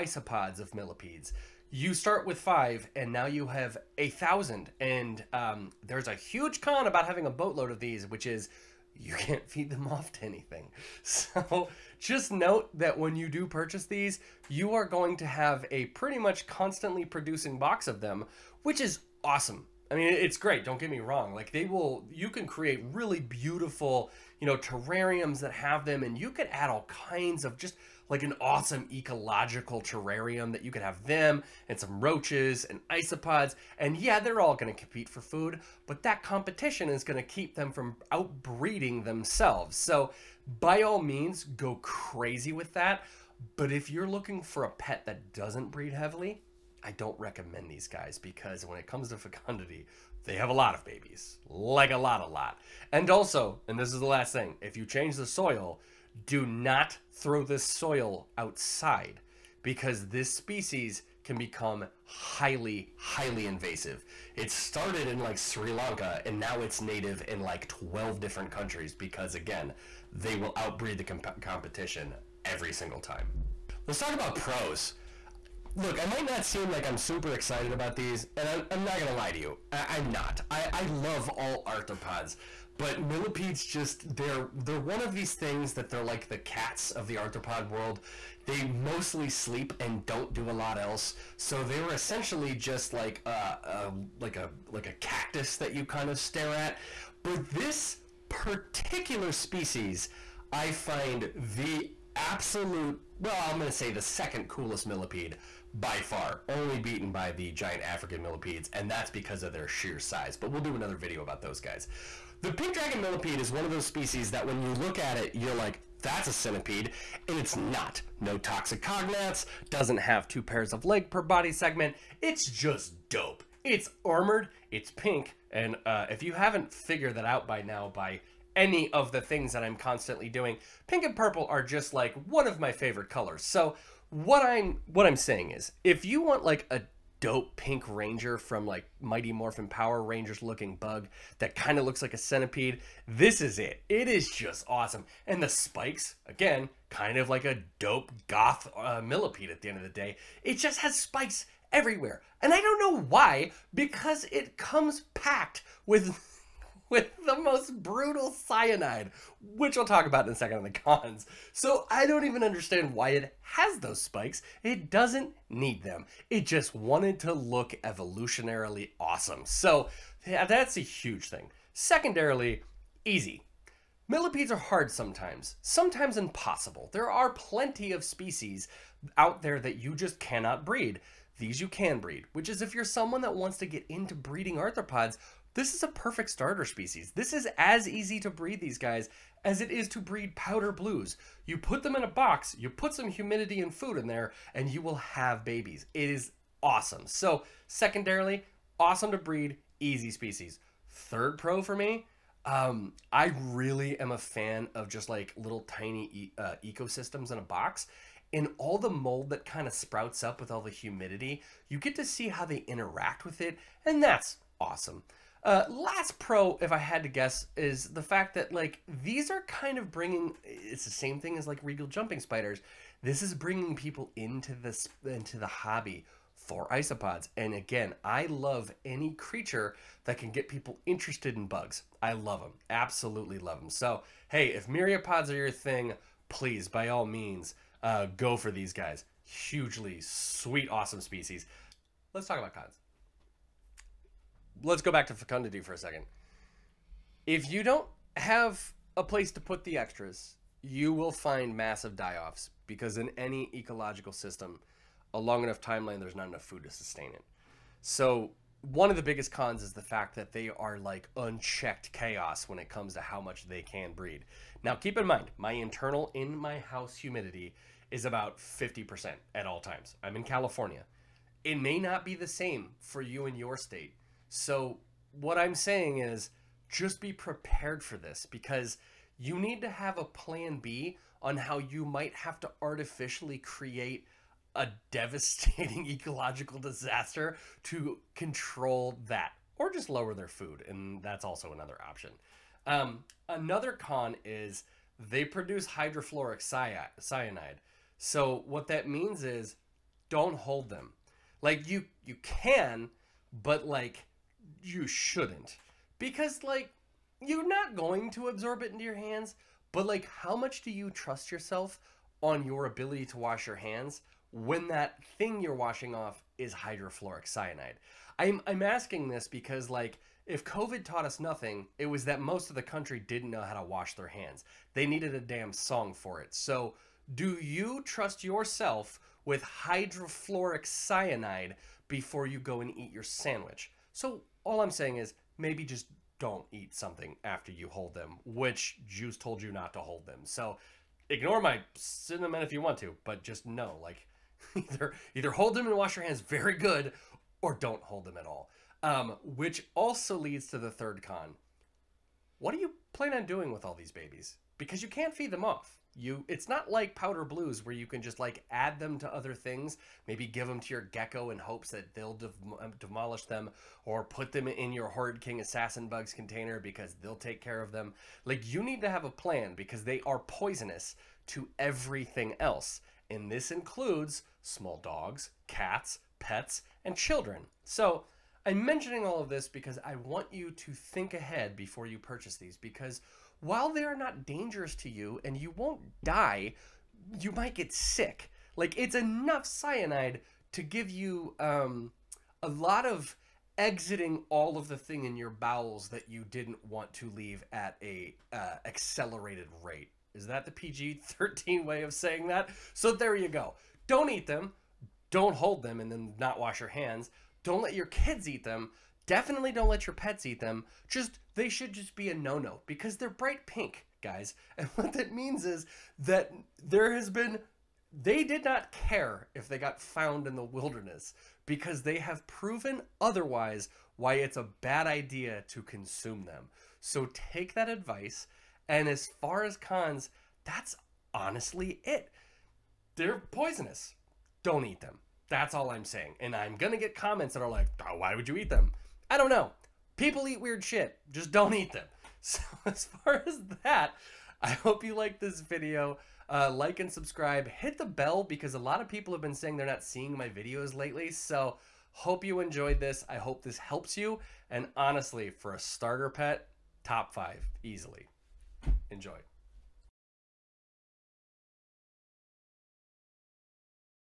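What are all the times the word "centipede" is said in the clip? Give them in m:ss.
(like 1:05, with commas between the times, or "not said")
1:56, 2:22.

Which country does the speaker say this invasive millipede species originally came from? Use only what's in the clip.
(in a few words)
Sri Lanka.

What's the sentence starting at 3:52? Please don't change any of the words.
I love them, absolutely love them.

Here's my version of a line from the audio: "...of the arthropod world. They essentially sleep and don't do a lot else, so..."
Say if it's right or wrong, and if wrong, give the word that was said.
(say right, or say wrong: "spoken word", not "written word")
wrong: "mostly", not "essentially".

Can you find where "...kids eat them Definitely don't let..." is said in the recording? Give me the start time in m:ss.
6:47.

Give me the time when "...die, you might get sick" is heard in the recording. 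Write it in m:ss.
6:26.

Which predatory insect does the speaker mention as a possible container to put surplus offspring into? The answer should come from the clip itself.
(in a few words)
king assassin bugs.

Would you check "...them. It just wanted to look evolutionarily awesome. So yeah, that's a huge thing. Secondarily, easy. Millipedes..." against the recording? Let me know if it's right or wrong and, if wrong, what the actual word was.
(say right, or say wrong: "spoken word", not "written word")
right.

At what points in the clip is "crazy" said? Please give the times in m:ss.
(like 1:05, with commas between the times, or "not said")
0:41.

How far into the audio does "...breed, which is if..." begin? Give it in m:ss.
3:01.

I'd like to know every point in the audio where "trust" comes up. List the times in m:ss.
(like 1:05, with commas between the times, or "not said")
5:10, 5:27.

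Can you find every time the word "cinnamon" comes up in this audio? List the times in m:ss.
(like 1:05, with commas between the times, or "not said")
5:41.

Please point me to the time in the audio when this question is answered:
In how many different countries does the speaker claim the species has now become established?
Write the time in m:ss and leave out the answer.
1:07.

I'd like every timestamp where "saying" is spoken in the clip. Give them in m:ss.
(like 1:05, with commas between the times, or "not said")
2:15, 4:35, 5:34, 6:41, 7:15, 7:29.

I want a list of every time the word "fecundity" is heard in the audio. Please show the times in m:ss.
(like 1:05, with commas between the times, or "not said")
0:49, 4:05.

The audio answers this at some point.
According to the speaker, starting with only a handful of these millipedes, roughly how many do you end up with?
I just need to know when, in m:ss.
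0:03.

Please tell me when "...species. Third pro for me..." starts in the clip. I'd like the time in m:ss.
3:20.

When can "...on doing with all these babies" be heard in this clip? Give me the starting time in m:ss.
5:53.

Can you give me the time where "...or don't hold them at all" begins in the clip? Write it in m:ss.
5:47.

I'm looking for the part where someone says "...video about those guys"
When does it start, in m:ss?
1:50.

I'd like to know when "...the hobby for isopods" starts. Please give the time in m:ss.
3:45.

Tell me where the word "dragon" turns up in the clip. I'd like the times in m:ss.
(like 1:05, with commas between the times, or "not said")
1:52.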